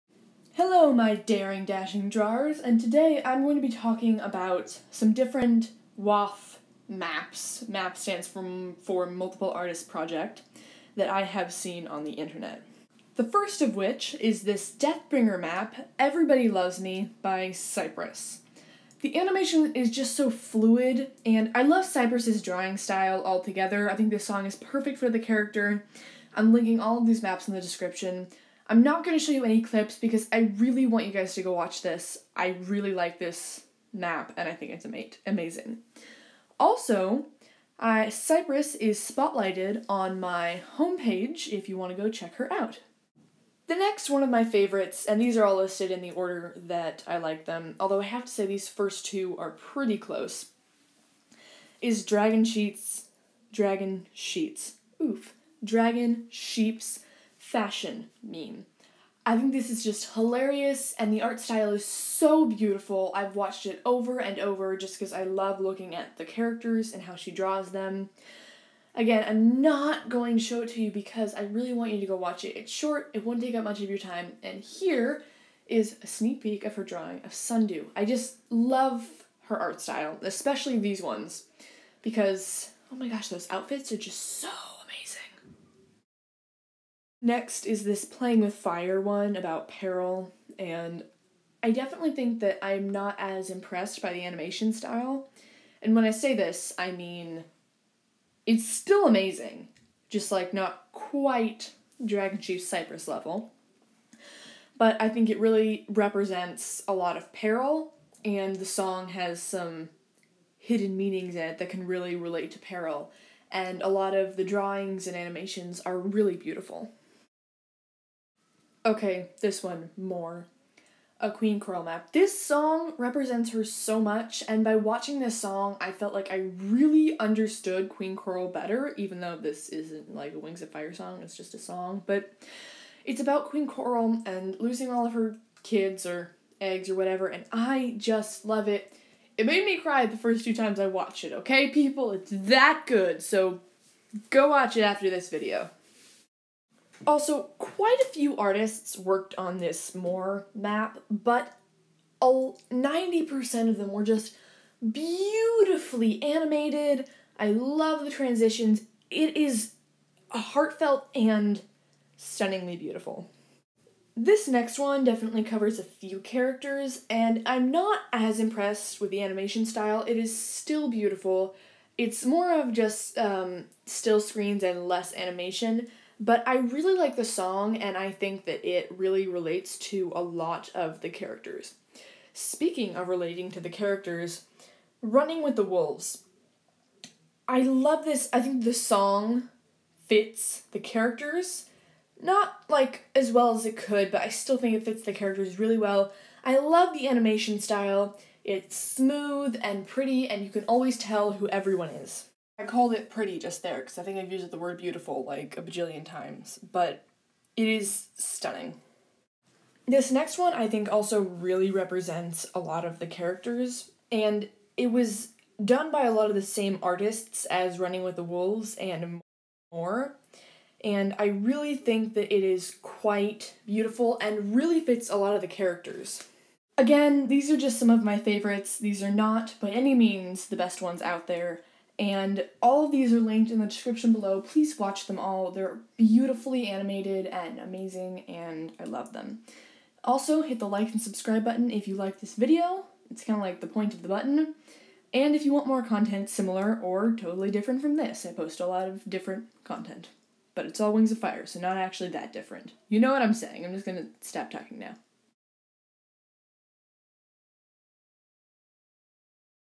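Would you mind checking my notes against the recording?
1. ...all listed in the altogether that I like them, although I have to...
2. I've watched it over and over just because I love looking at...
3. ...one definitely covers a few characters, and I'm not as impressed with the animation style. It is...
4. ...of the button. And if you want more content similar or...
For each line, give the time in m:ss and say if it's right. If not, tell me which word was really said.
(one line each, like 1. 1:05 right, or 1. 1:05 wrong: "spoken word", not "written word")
1. 0:45 wrong: "order", not "altogether"
2. 1:03 right
3. 2:44 right
4. 4:03 right.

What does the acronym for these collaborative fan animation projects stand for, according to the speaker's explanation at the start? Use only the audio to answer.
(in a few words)
Multiple Artist Project.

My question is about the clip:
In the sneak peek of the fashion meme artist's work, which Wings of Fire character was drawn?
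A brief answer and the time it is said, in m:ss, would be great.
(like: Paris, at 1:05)
Sundew, at 1:17.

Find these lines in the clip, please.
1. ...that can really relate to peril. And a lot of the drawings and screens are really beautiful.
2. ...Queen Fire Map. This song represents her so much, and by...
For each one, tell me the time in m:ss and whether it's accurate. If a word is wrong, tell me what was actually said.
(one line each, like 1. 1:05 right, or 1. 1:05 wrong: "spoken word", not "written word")
1. 1:51 wrong: "animations", not "screens"
2. 2:01 wrong: "Coral", not "Fire".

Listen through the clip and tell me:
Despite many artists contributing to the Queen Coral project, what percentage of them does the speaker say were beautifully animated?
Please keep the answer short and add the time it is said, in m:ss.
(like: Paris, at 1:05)
90%, at 2:32.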